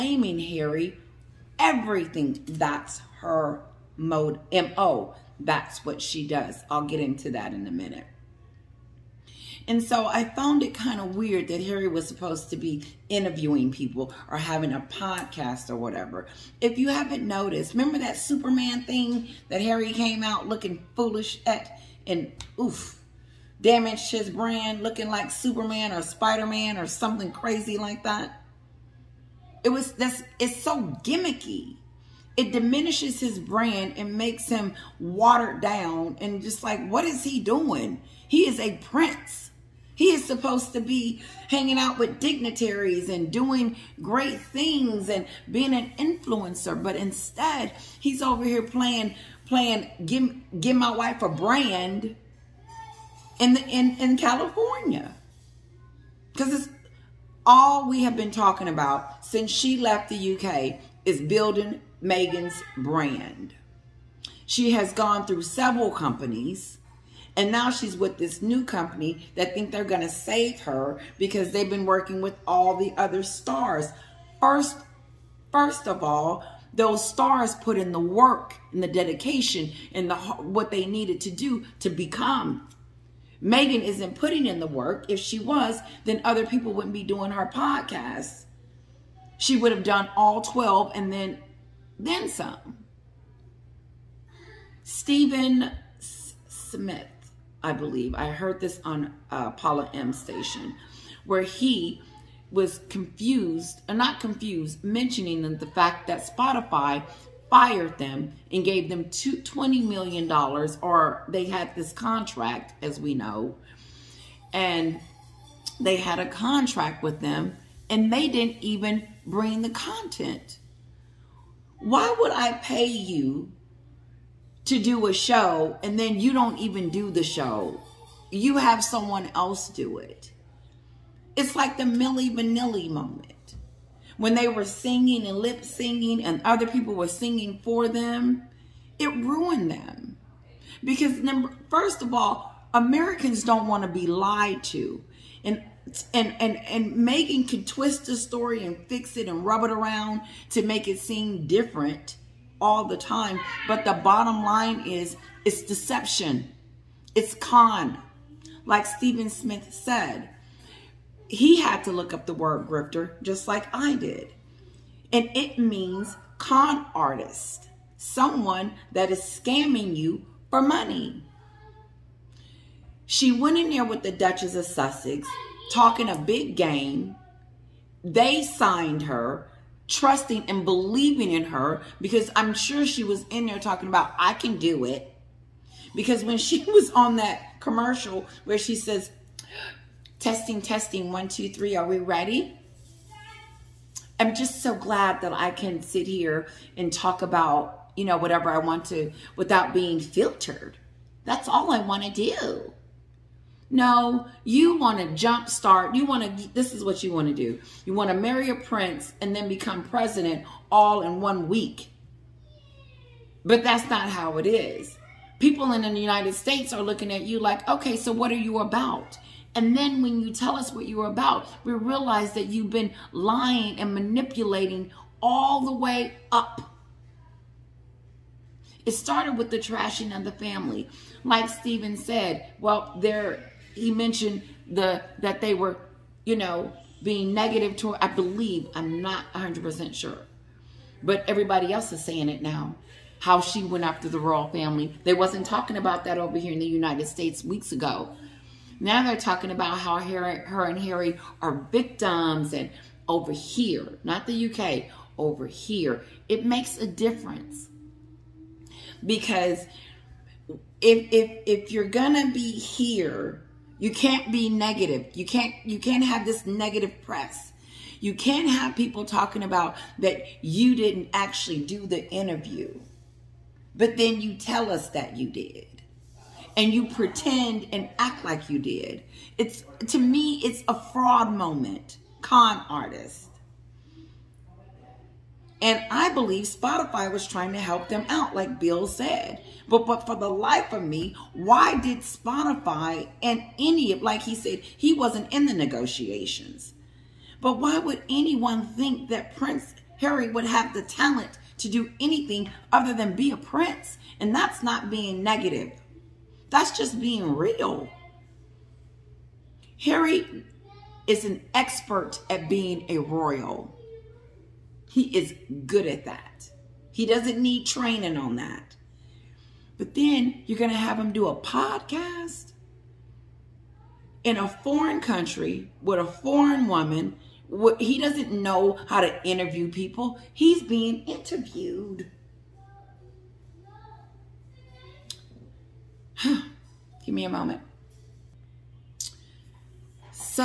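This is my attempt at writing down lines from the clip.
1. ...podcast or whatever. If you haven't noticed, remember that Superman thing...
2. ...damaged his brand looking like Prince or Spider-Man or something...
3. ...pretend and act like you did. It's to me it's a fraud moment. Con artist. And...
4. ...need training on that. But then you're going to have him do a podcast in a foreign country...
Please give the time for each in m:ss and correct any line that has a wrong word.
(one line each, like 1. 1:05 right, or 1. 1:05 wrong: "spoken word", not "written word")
1. 0:14 right
2. 0:23 wrong: "Superman", not "Prince"
3. 4:36 right
4. 5:17 right.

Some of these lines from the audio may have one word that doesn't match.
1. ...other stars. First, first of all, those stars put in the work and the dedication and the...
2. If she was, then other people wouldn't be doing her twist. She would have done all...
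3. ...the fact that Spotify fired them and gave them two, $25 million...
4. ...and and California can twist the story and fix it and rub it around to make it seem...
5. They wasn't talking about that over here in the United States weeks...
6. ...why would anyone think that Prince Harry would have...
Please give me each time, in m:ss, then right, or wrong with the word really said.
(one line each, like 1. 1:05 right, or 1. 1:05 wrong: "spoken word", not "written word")
1. 1:12 right
2. 1:25 wrong: "podcast", not "twist"
3. 1:45 wrong: "20", not "25"
4. 2:26 wrong: "Meghan", not "California"
5. 4:05 right
6. 4:57 right.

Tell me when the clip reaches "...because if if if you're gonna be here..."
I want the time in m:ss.
4:19.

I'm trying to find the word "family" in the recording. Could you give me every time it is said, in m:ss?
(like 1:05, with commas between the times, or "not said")
3:50, 4:04.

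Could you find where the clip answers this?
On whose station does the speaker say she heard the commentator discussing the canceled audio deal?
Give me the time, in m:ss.
1:39.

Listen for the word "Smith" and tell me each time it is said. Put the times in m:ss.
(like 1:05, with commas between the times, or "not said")
1:36, 2:39.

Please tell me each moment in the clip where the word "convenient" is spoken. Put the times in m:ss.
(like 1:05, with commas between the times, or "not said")
not said.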